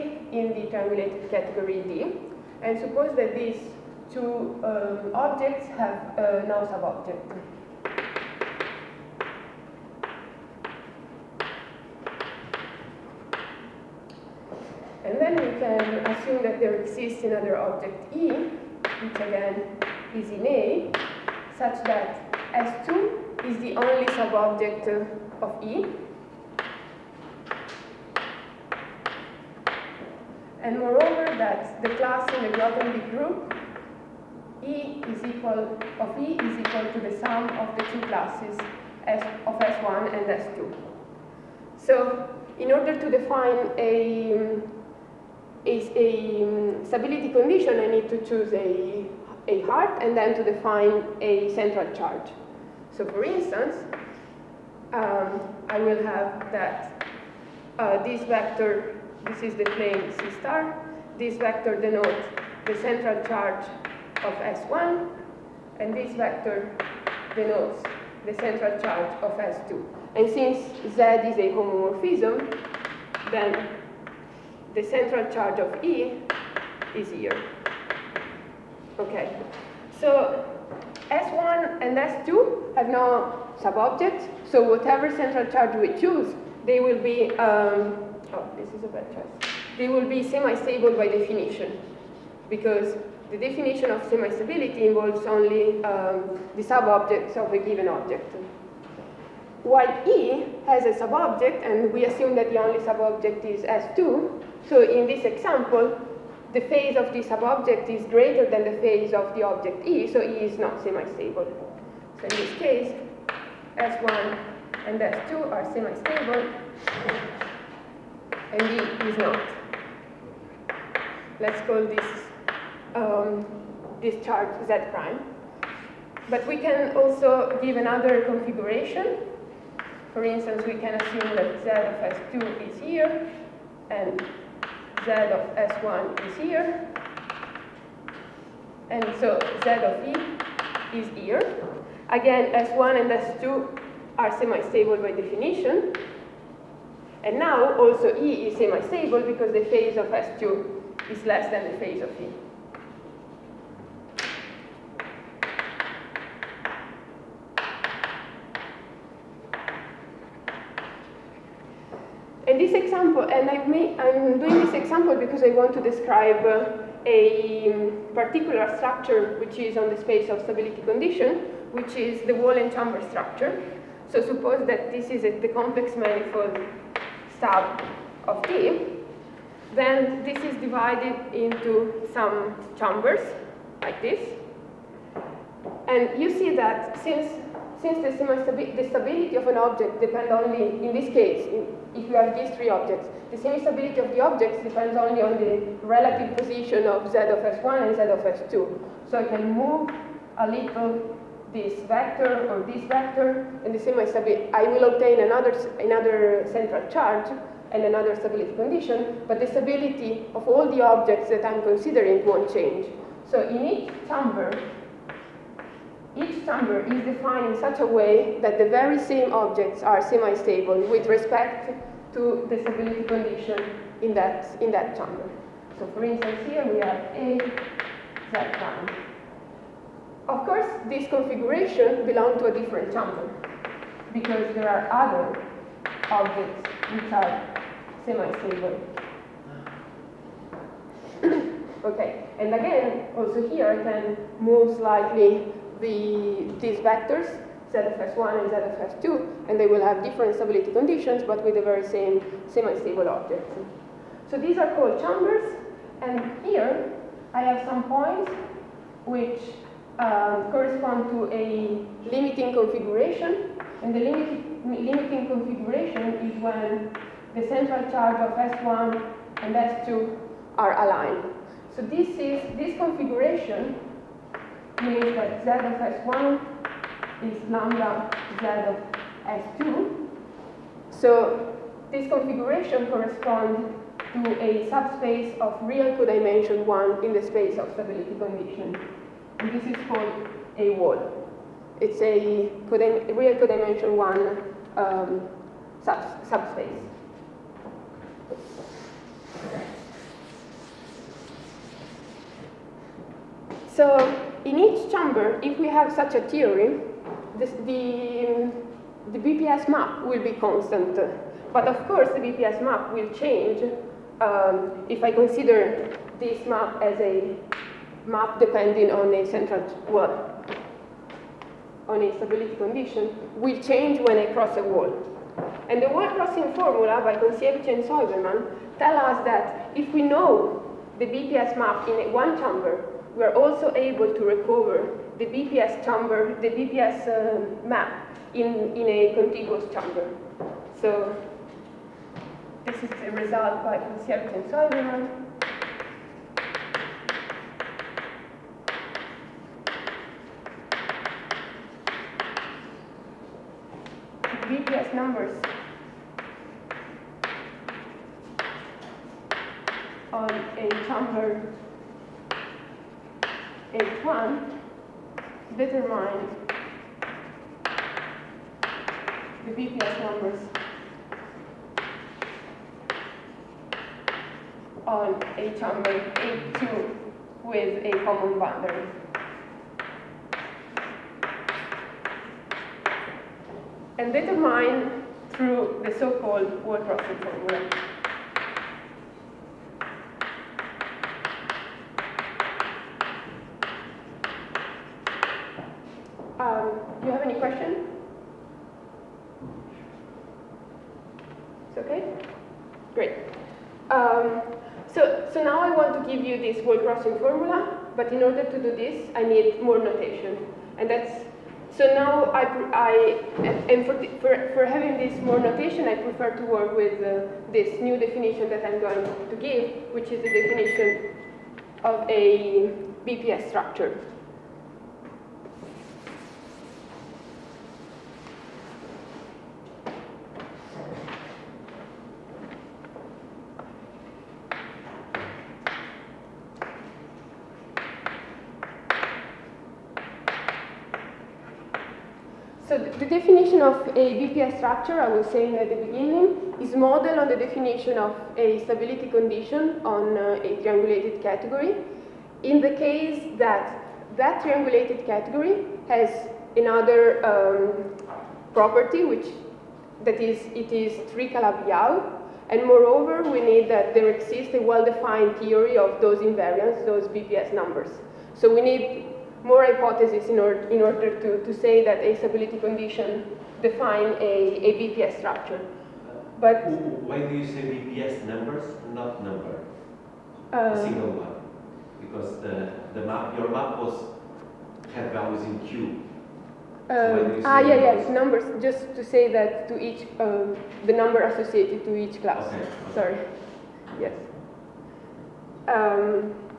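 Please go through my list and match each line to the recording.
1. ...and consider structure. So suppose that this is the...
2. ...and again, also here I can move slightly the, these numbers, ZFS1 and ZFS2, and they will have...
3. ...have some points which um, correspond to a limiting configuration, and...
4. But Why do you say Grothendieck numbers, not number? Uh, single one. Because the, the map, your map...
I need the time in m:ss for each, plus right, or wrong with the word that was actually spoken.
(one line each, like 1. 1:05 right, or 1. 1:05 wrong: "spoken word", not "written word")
1. 2:52 wrong: "chamber", not "consider"
2. 4:02 wrong: "vectors", not "numbers"
3. 4:17 right
4. 7:56 wrong: "BPS", not "Grothendieck".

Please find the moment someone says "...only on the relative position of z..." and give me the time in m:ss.
3:14.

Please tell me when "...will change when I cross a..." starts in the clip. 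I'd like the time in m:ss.
5:23.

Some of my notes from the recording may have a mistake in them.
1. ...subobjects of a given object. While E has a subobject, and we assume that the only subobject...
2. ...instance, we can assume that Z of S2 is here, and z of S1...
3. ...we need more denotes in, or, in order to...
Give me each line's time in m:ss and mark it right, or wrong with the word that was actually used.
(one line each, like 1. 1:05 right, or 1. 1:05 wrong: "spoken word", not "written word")
1. 1:36 right
2. 2:10 right
3. 7:48 wrong: "hypotheses", not "denotes".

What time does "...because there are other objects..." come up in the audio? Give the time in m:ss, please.
3:54.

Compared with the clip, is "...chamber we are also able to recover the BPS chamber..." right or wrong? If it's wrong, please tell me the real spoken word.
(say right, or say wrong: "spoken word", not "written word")
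right.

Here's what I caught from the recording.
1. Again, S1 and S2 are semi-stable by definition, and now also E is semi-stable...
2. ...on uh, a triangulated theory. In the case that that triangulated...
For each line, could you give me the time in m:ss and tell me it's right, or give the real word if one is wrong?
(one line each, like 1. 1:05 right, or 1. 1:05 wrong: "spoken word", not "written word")
1. 2:22 right
2. 7:29 wrong: "category", not "theory".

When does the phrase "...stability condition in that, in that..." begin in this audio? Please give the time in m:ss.
3:42.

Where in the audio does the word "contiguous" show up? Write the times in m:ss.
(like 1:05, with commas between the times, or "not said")
5:39.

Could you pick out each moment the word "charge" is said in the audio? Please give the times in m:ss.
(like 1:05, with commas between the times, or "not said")
0:51, 1:03, 1:08, 1:15, 1:25, 2:04, 3:26, 4:27.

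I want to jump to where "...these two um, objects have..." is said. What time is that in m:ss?
0:03.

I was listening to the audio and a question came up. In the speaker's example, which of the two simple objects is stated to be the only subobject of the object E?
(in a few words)
S2.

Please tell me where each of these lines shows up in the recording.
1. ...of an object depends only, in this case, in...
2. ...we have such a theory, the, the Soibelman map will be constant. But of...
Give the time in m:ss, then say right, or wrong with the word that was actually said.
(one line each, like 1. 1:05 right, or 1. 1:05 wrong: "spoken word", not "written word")
1. 3:09 right
2. 5:05 wrong: "BPS", not "Soibelman".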